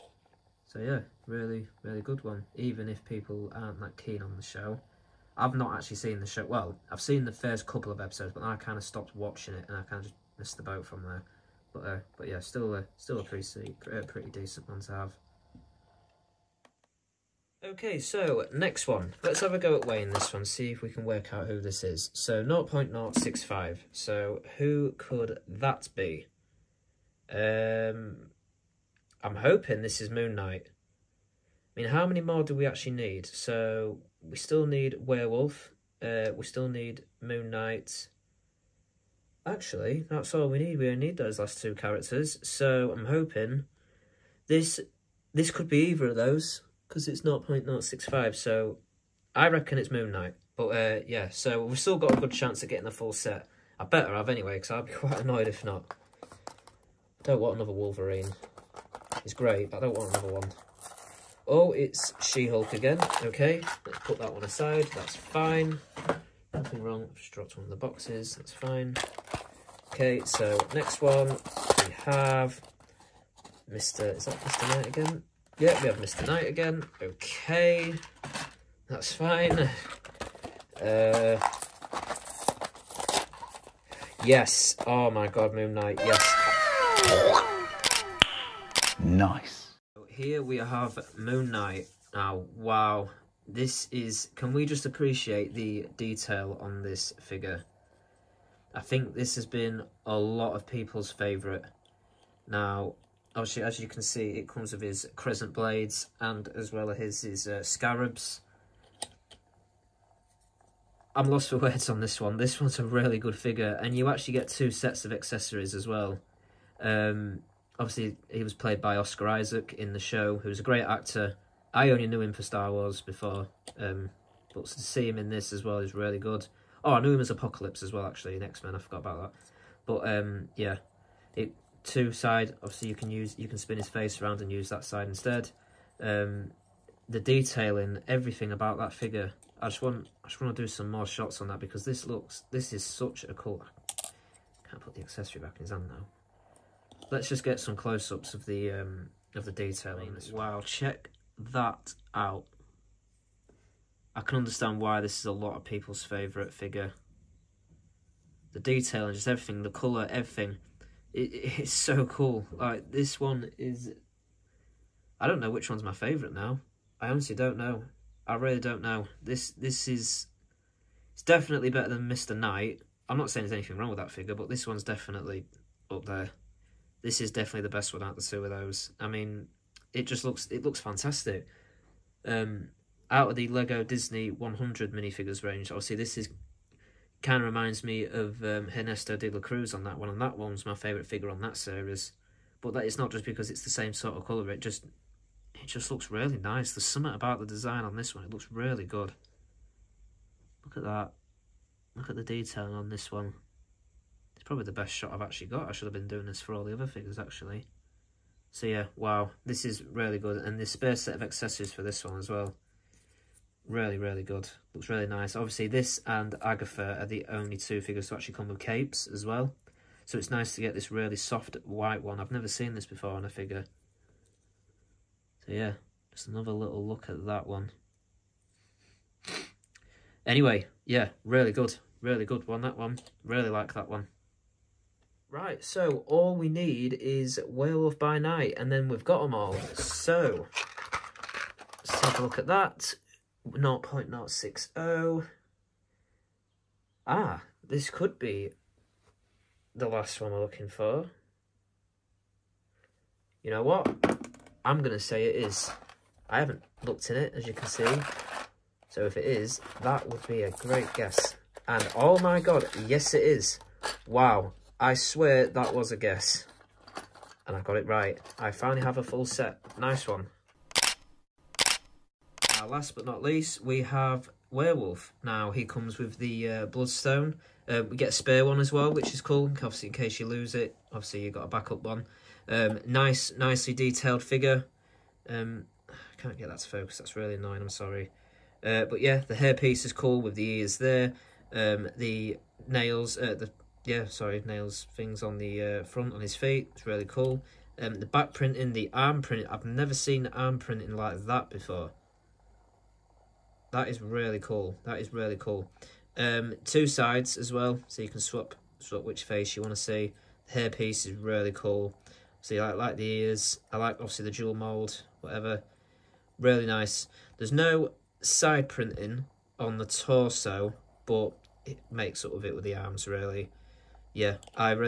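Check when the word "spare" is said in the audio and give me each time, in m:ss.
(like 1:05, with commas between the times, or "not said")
3:30, 4:38.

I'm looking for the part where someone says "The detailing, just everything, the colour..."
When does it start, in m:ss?
2:38.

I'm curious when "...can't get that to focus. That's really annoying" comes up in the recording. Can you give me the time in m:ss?
4:46.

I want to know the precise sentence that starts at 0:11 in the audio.
But uh, but yeah, still a, still a pretty, uh, pretty decent one to have.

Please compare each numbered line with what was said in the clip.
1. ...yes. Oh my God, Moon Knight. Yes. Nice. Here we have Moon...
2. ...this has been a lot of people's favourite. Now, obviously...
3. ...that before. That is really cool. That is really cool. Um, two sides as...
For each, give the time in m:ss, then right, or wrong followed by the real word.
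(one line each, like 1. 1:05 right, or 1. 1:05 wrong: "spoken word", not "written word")
1. 1:24 right
2. 1:39 right
3. 5:01 right.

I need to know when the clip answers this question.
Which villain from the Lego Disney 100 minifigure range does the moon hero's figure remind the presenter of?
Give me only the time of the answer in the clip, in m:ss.
3:08.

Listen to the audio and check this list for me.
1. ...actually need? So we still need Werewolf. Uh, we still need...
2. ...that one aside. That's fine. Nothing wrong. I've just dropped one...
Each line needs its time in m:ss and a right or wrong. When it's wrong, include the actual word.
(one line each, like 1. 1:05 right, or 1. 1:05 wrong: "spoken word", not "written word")
1. 0:32 right
2. 1:04 right.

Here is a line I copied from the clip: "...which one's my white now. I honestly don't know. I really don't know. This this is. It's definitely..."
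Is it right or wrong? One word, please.
wrong.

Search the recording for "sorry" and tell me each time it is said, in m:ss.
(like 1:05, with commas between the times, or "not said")
4:47, 4:54.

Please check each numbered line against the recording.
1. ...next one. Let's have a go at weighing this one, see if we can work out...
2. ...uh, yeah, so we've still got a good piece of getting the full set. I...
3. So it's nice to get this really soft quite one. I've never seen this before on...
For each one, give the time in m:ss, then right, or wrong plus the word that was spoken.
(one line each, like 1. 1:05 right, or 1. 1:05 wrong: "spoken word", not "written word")
1. 0:18 right
2. 0:50 wrong: "chance", not "piece"
3. 3:40 wrong: "white", not "quite".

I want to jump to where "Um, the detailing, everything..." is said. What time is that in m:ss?
2:16.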